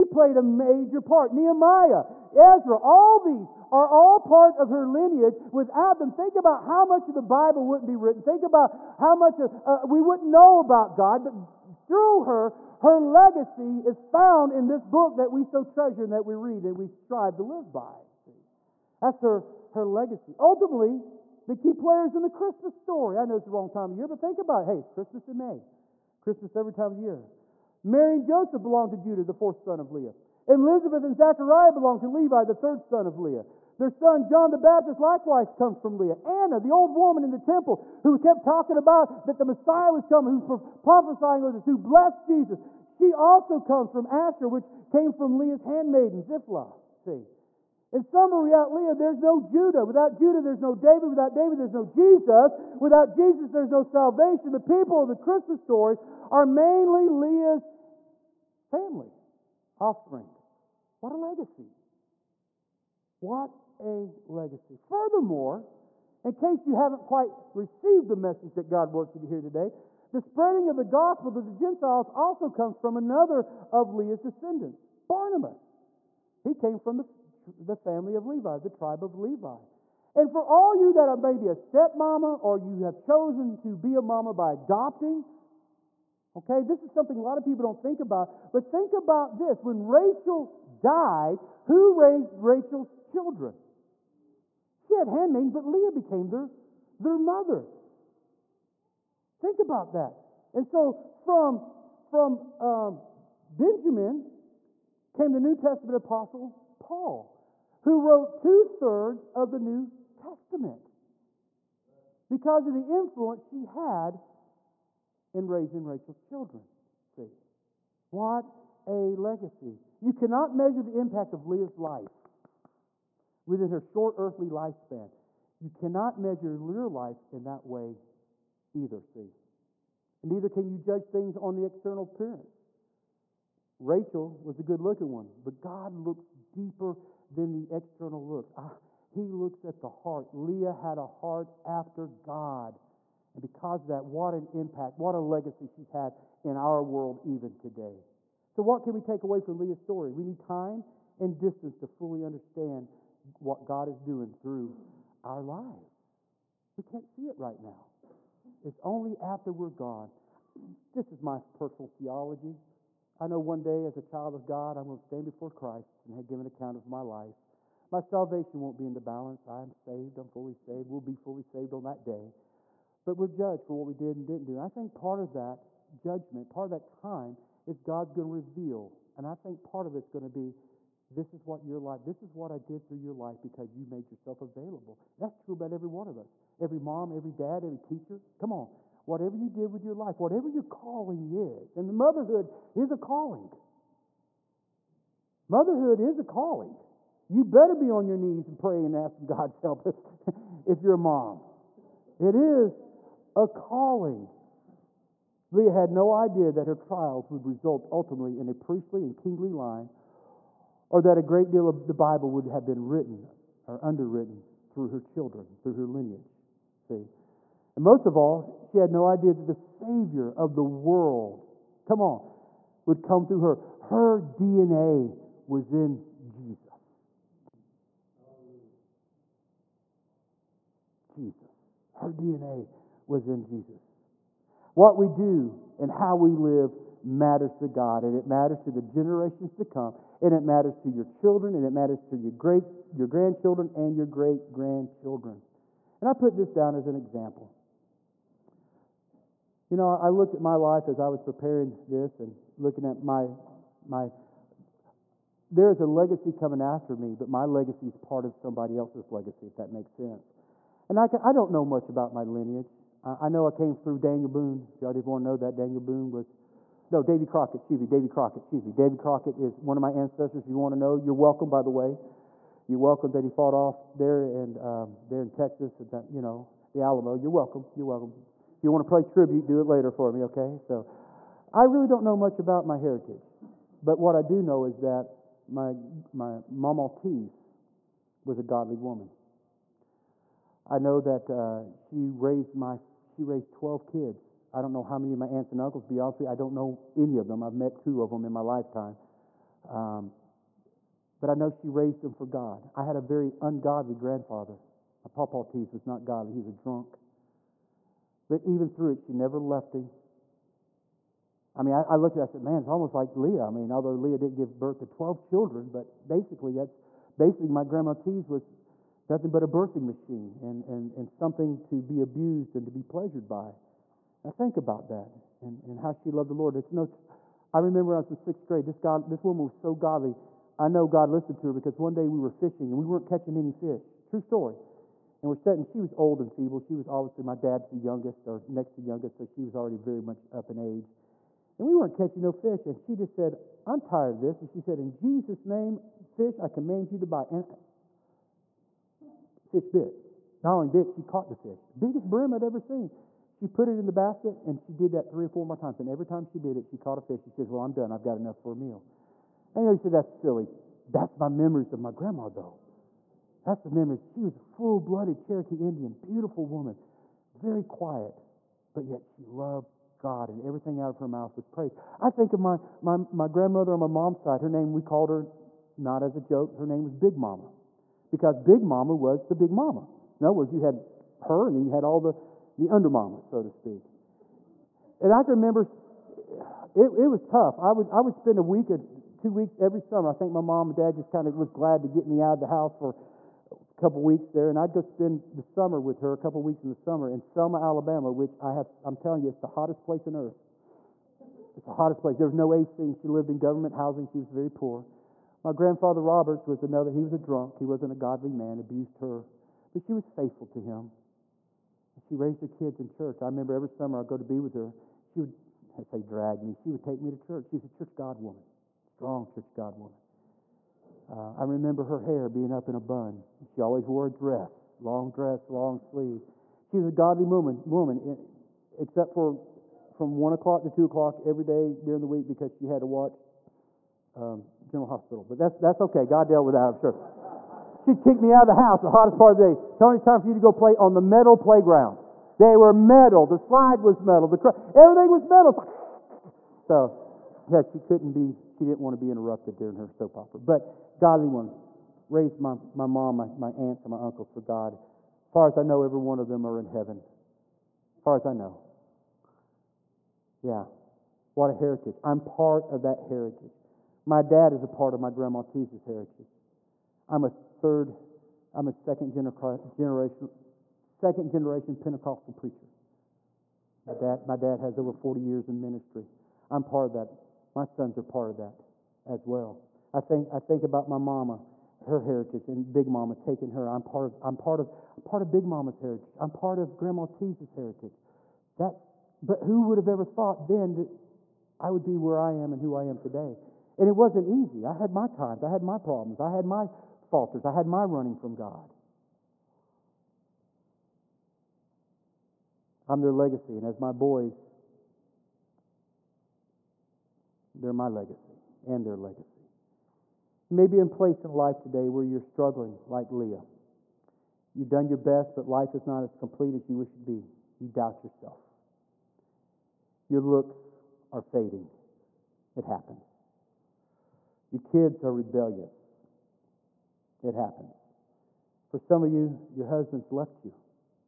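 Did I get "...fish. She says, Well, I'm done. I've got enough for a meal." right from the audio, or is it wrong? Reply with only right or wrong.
right.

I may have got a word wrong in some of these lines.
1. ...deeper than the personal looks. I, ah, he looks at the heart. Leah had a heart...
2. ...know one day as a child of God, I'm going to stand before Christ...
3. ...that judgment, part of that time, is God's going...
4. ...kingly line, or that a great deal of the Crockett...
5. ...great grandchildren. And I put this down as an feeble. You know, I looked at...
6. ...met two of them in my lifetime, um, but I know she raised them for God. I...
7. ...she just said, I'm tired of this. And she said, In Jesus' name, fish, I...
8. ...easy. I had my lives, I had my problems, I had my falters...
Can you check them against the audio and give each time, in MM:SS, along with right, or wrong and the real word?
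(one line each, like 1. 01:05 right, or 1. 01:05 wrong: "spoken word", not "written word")
1. 02:16 wrong: "external", not "personal"
2. 02:43 right
3. 02:55 right
4. 03:29 wrong: "Bible", not "Crockett"
5. 04:04 wrong: "example", not "feeble"
6. 04:57 right
7. 05:42 right
8. 08:14 wrong: "times", not "lives".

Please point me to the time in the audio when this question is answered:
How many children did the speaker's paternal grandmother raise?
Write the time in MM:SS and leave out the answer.
04:53.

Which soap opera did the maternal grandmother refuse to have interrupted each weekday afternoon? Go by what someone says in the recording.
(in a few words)
General Hospital.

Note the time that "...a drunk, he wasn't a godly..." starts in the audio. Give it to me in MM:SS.
06:47.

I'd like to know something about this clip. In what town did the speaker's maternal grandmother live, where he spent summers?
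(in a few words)
Selma, Alabama.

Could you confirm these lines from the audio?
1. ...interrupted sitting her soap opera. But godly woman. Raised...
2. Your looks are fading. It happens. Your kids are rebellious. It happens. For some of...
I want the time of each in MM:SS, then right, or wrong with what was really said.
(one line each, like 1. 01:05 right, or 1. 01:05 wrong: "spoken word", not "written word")
1. 07:29 wrong: "during", not "sitting"
2. 08:40 right.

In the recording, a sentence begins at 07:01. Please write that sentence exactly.
Uh, I remember her hair being up in a bun.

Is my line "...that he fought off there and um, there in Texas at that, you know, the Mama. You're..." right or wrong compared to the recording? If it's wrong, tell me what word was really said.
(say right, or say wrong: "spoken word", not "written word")
wrong: "Alamo", not "Mama".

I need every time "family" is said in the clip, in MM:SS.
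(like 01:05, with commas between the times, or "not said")
00:58, 01:17.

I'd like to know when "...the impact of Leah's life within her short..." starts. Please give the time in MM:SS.
02:00.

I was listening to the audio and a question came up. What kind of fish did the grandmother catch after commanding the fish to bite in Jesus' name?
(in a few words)
Brim.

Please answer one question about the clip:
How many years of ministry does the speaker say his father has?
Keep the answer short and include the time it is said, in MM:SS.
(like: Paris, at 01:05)
Over 40, at 07:54.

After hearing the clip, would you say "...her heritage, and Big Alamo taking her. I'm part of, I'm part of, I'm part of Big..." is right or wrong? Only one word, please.
wrong.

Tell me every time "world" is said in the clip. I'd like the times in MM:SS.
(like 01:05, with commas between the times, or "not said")
02:26, 03:40.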